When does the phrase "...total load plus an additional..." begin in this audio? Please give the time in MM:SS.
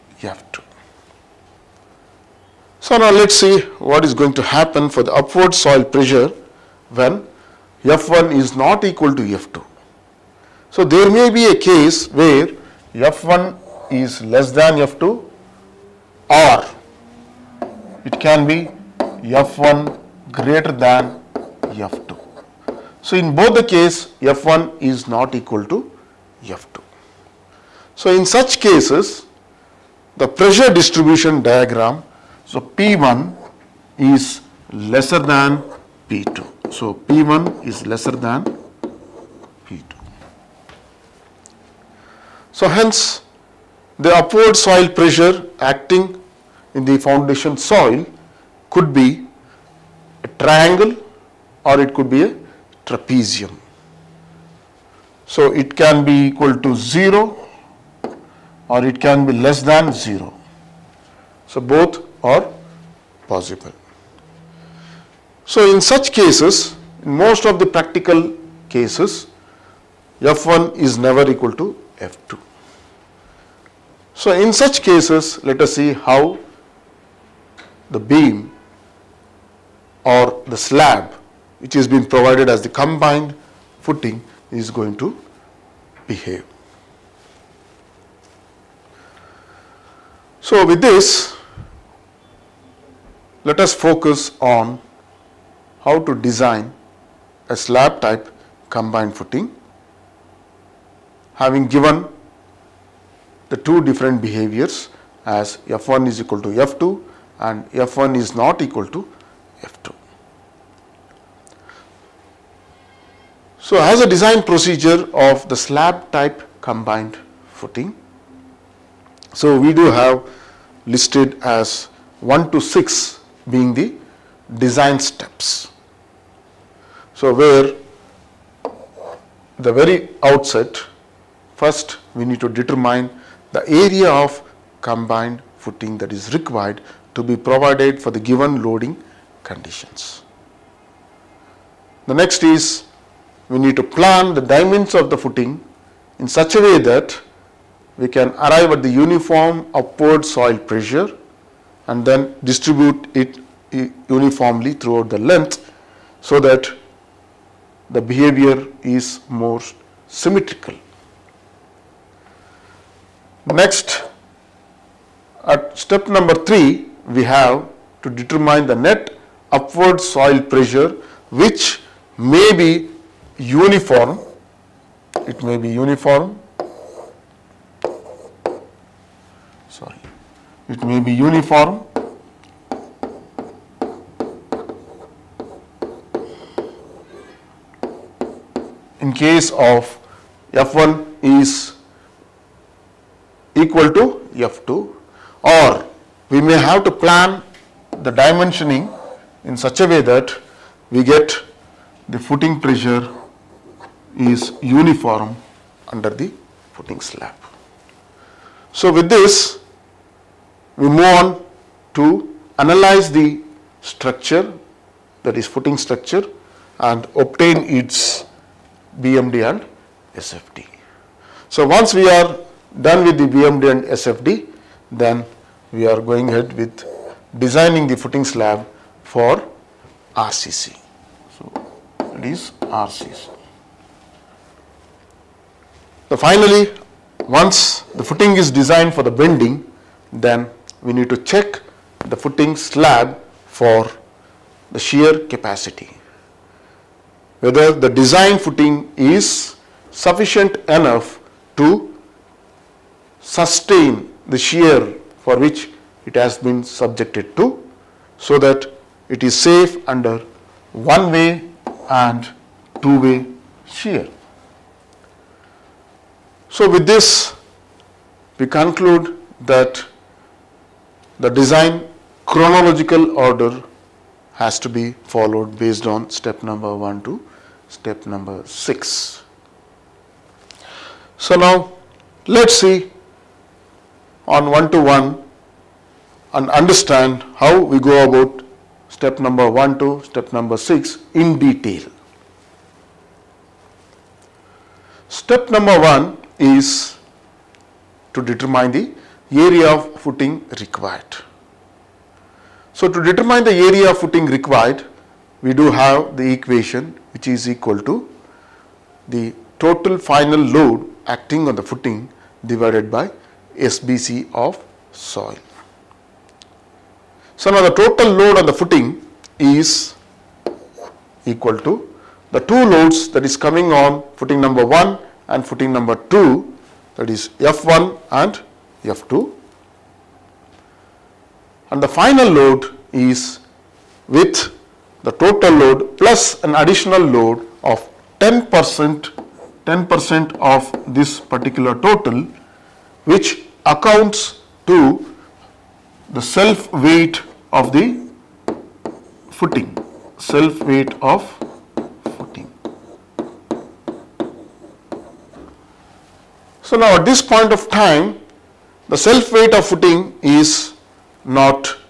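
05:35.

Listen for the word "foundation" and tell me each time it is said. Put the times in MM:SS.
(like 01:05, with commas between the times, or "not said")
00:46.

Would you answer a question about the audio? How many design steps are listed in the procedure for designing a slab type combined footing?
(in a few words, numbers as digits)
6.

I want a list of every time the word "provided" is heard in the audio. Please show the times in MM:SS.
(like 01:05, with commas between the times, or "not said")
01:22, 02:17.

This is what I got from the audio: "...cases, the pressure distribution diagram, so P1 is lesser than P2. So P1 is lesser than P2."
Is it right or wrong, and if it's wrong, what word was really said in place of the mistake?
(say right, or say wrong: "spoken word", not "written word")
right.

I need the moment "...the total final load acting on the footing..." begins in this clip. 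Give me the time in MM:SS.
05:09.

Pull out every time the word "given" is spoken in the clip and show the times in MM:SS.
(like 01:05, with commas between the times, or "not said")
01:41, 02:18.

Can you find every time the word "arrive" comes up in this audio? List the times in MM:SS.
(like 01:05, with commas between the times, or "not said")
02:28.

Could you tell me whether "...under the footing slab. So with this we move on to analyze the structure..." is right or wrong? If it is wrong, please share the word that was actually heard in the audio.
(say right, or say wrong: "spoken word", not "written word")
right.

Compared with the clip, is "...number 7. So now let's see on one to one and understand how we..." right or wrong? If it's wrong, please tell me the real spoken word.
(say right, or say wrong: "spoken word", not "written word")
wrong: "6", not "7".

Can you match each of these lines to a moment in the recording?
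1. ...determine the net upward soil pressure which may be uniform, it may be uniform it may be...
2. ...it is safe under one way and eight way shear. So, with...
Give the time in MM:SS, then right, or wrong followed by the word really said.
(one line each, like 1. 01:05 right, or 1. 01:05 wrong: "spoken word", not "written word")
1. 02:48 right
2. 04:19 wrong: "two", not "eight".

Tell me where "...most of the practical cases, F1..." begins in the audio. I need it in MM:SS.
01:07.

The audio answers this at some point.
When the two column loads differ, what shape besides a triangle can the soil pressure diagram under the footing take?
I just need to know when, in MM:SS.
00:52.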